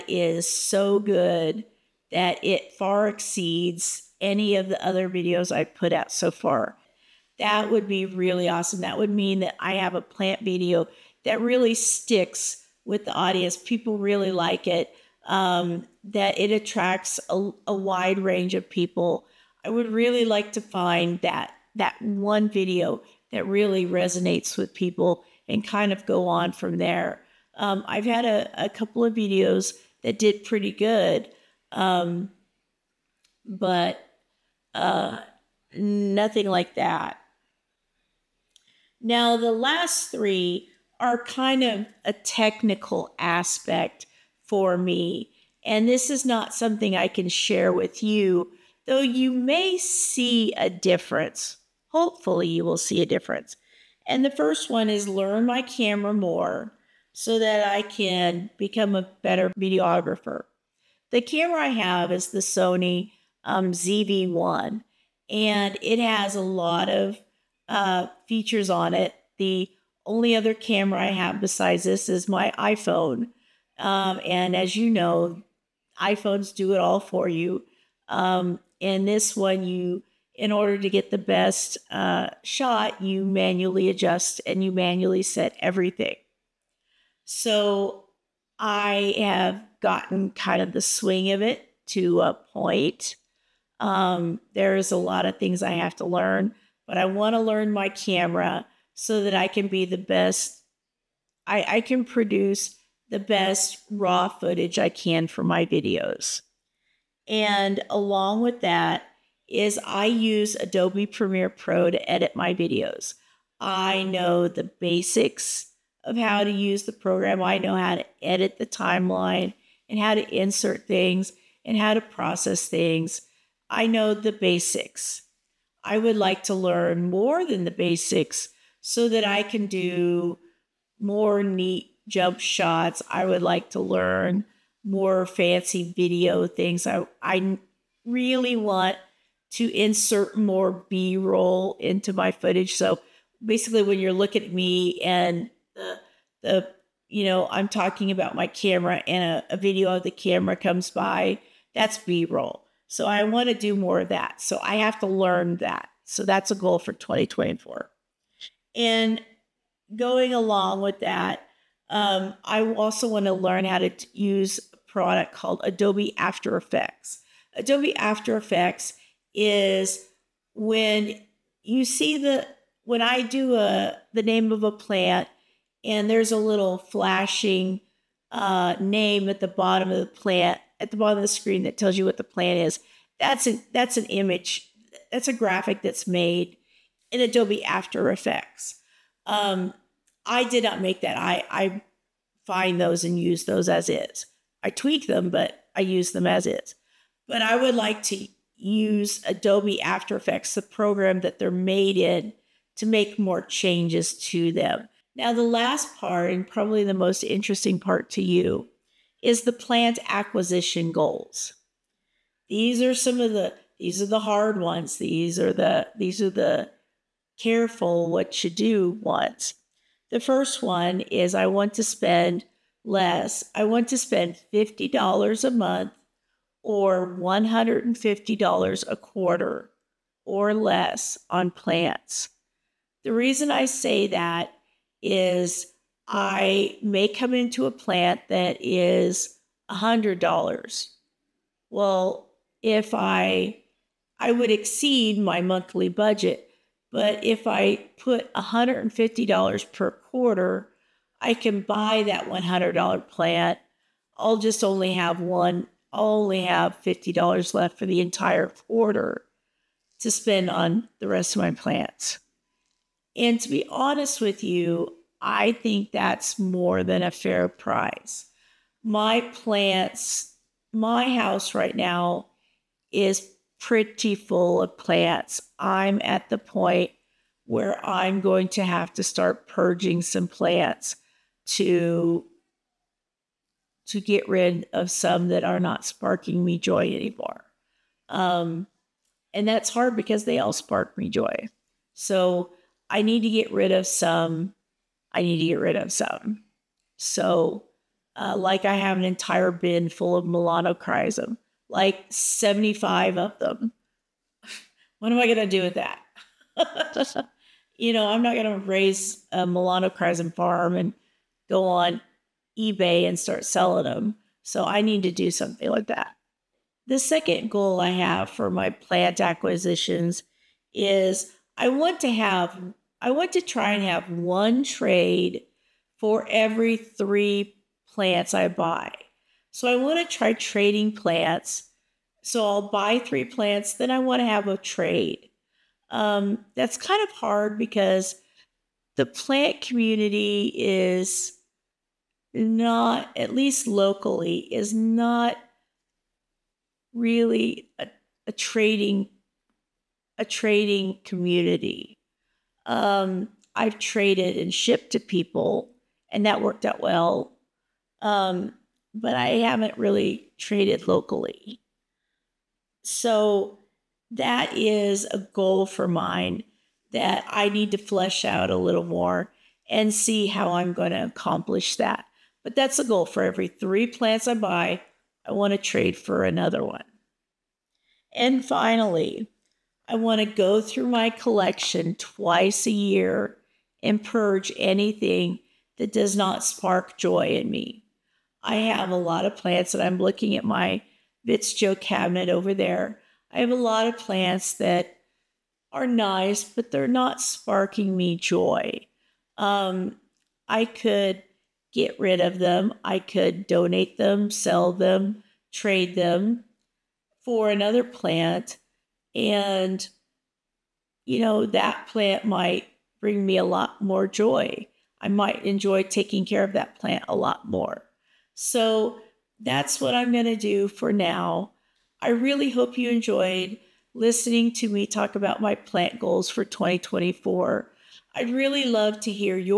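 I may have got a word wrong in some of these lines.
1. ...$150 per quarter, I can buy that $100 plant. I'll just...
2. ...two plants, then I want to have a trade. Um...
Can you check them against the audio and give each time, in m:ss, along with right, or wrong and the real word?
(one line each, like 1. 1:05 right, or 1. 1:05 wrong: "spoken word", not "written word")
1. 4:08 right
2. 5:32 wrong: "three", not "two".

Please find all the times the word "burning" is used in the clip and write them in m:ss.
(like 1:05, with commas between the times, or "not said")
not said.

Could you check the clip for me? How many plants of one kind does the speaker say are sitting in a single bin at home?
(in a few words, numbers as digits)
75.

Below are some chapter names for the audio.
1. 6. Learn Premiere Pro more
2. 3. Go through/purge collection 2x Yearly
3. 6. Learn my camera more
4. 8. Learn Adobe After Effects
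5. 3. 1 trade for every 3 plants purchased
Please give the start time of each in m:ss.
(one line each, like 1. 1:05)
1. 2:06
2. 6:19
3. 0:54
4. 2:43
5. 5:23.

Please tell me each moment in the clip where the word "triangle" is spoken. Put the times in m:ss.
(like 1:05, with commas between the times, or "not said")
not said.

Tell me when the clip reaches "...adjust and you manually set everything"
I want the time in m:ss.
1:23.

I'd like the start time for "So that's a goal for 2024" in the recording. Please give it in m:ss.
2:36.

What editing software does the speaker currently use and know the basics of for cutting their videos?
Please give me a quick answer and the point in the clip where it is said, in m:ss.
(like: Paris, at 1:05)
Adobe Premiere Pro, at 1:50.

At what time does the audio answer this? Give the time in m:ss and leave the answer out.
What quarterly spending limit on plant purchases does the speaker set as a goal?
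3:47.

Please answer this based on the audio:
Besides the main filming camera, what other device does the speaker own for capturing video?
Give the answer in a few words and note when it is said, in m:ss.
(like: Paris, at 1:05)
iPhone, at 1:12.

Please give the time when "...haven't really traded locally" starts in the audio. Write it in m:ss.
5:59.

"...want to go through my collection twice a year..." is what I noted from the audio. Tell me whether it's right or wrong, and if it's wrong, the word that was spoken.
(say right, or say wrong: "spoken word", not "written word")
right.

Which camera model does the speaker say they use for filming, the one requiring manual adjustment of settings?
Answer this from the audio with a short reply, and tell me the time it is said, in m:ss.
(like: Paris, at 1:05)
Sony ZV1, at 1:02.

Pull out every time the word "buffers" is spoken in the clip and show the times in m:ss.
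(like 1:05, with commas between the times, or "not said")
not said.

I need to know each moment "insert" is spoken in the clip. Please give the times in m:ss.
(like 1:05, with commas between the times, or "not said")
2:00, 2:19.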